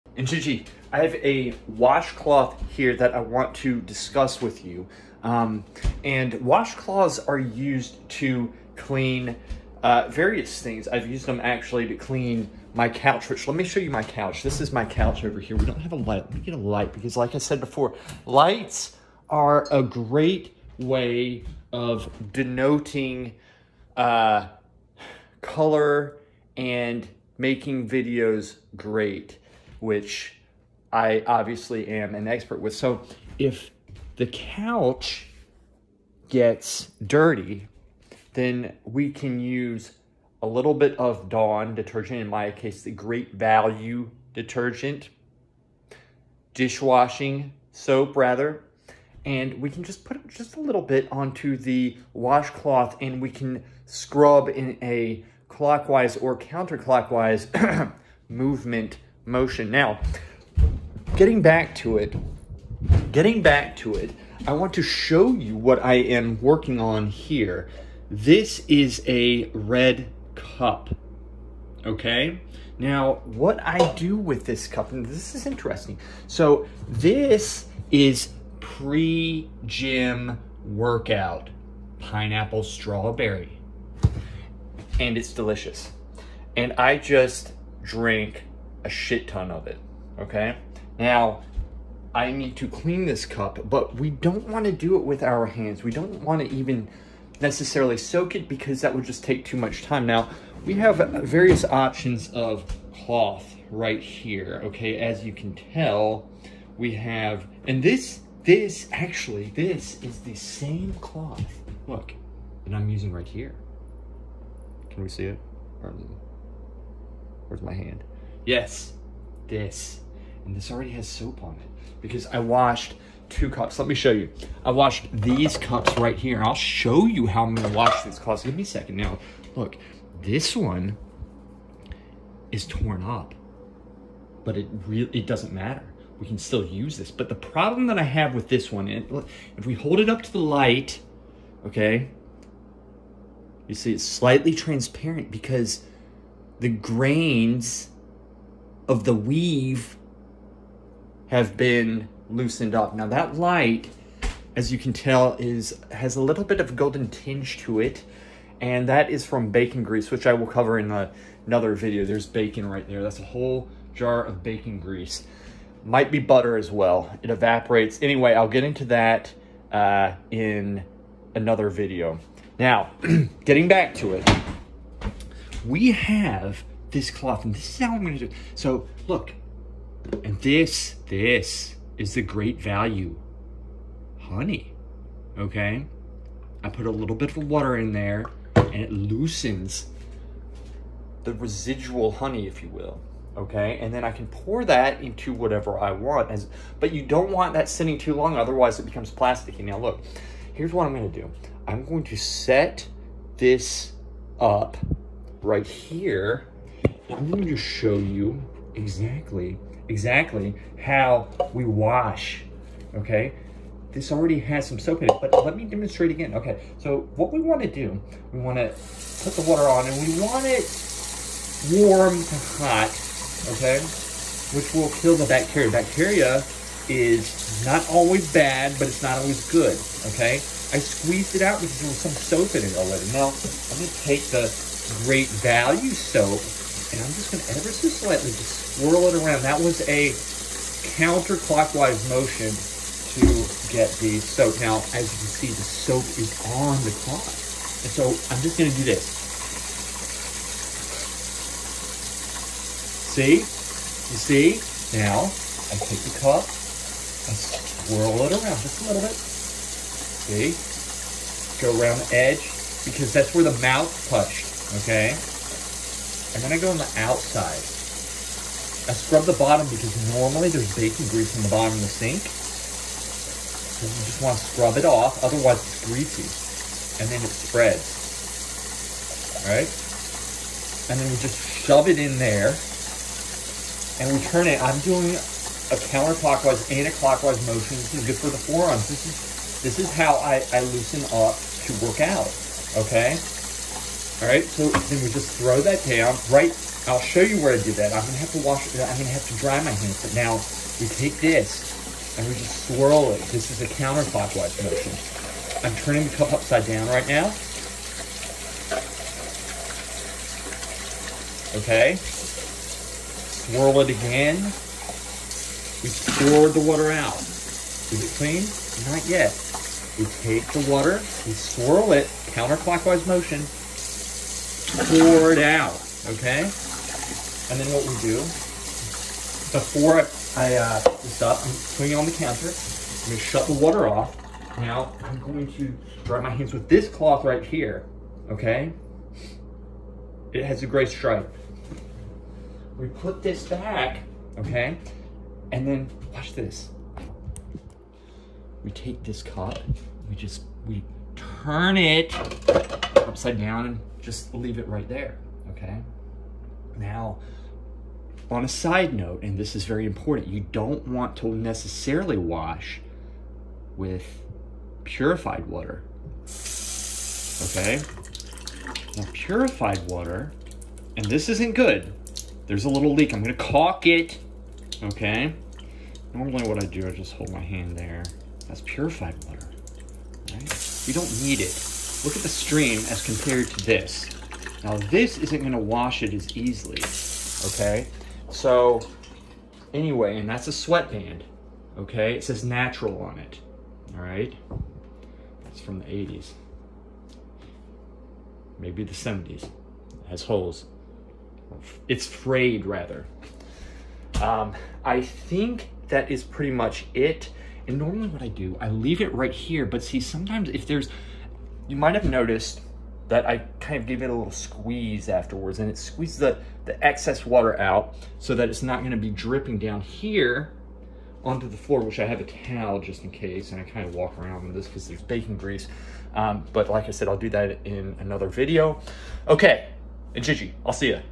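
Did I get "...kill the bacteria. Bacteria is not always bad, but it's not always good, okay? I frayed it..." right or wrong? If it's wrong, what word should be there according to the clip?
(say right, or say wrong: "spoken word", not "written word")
wrong: "squeezed", not "frayed".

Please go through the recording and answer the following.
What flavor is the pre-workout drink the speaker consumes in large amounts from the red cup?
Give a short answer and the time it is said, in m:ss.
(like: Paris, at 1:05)
Pineapple strawberry, at 1:21.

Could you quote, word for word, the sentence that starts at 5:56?
Now, on a side note, and this is very important, you don't want to necessarily wash with purified water, okay?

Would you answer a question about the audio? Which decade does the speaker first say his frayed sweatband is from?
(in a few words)
The 80s.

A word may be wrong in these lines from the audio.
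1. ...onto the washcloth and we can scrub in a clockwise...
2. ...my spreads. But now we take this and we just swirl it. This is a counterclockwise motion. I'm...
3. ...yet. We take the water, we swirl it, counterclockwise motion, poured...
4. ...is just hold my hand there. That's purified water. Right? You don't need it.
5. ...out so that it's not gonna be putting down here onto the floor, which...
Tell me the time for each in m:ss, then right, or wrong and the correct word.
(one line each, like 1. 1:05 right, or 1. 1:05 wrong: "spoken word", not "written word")
1. 0:51 right
2. 4:59 wrong: "hands", not "spreads"
3. 5:19 right
4. 6:16 right
5. 6:57 wrong: "dripping", not "putting".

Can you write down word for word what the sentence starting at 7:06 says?
Um, but like I said, I'll do that in another video.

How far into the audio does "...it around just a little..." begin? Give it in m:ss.
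4:18.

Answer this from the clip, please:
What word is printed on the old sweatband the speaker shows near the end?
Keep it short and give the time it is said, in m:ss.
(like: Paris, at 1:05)
Natural, at 6:32.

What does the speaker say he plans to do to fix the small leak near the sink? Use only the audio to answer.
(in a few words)
Caulk it.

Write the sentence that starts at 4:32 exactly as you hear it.
So you just want to scrub it off, otherwise it's greasy.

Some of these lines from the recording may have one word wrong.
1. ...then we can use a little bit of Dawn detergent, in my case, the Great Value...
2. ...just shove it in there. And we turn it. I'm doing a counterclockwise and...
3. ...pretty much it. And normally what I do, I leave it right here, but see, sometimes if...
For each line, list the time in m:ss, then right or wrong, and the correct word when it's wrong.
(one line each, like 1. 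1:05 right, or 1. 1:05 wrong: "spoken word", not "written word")
1. 0:38 right
2. 4:41 right
3. 6:46 right.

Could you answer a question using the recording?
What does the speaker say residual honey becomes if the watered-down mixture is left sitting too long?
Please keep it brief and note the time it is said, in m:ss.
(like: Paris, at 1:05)
Plasticky, at 3:19.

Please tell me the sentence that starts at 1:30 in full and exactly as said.
Now, I need to clean this cup, but we don't want to do it with our hands.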